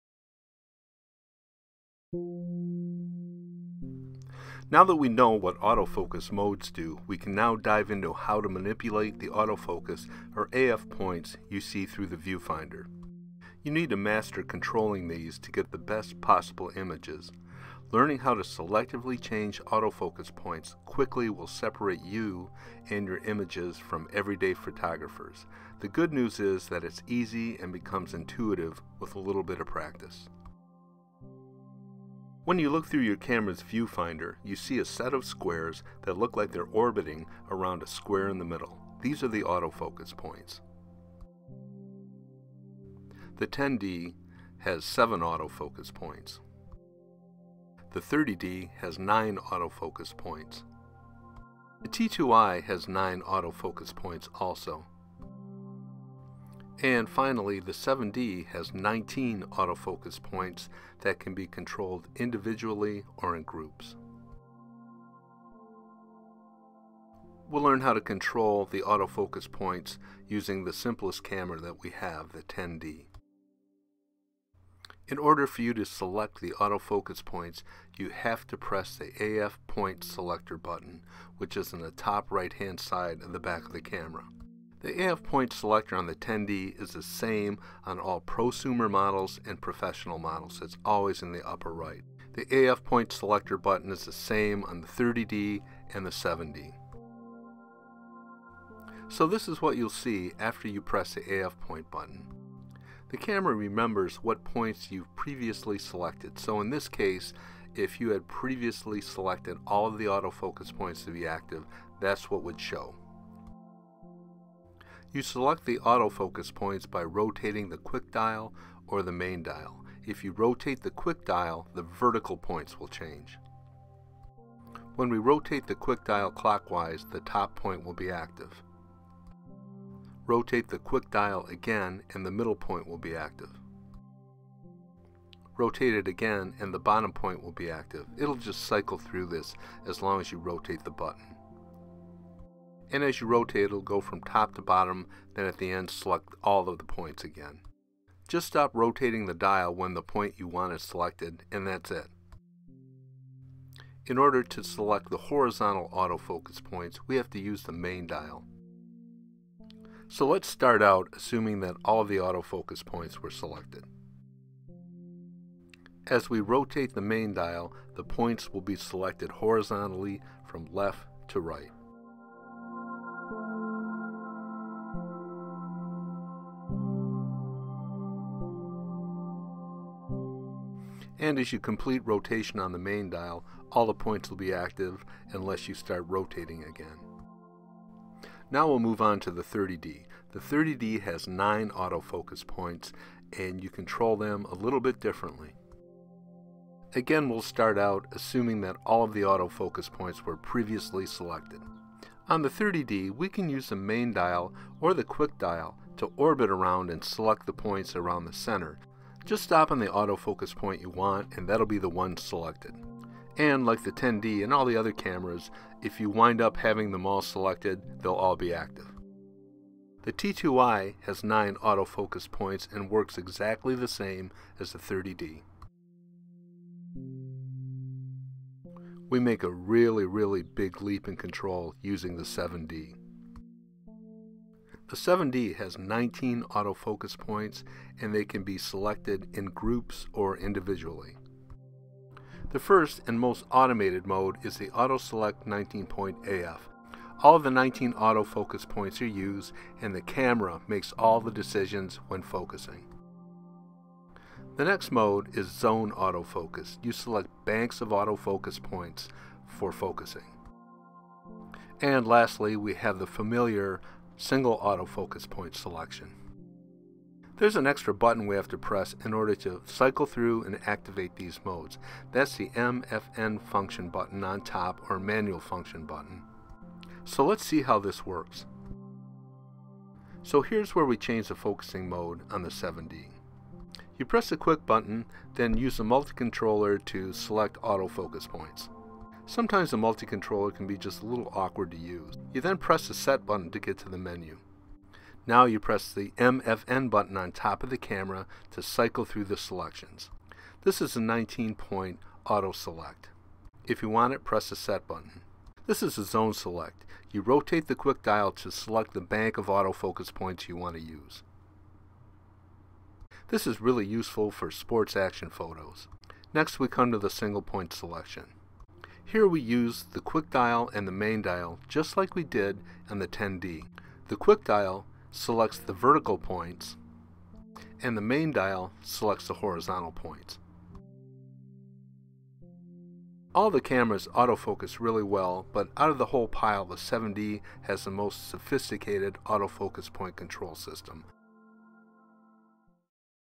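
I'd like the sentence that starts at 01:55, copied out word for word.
You select the autofocus points by rotating the quick dial or the main dial.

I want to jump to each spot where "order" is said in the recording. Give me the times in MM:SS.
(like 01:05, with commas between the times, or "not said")
01:15, 02:34, 04:29.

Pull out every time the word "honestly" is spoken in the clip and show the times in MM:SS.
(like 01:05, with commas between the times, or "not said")
not said.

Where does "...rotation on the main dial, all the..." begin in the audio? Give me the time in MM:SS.
03:02.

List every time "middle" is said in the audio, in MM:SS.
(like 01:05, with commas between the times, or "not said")
00:38, 02:12.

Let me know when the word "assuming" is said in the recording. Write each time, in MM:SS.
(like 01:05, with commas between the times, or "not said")
02:41, 03:18.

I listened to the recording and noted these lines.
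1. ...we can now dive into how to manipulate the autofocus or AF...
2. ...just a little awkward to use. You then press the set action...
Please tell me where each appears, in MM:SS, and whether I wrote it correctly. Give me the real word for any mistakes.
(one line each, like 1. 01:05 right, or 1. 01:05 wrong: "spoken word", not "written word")
1. 00:07 right
2. 04:50 wrong: "button", not "action".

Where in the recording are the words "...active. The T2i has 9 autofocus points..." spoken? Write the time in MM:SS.
03:38.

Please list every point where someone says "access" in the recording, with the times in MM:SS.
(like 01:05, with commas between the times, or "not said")
not said.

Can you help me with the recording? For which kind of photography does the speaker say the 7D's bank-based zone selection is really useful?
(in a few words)
sports action photos.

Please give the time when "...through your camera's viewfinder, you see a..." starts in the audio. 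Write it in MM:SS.
00:32.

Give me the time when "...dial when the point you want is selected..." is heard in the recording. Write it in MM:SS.
02:29.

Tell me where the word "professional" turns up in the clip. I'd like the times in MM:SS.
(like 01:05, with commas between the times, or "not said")
01:29.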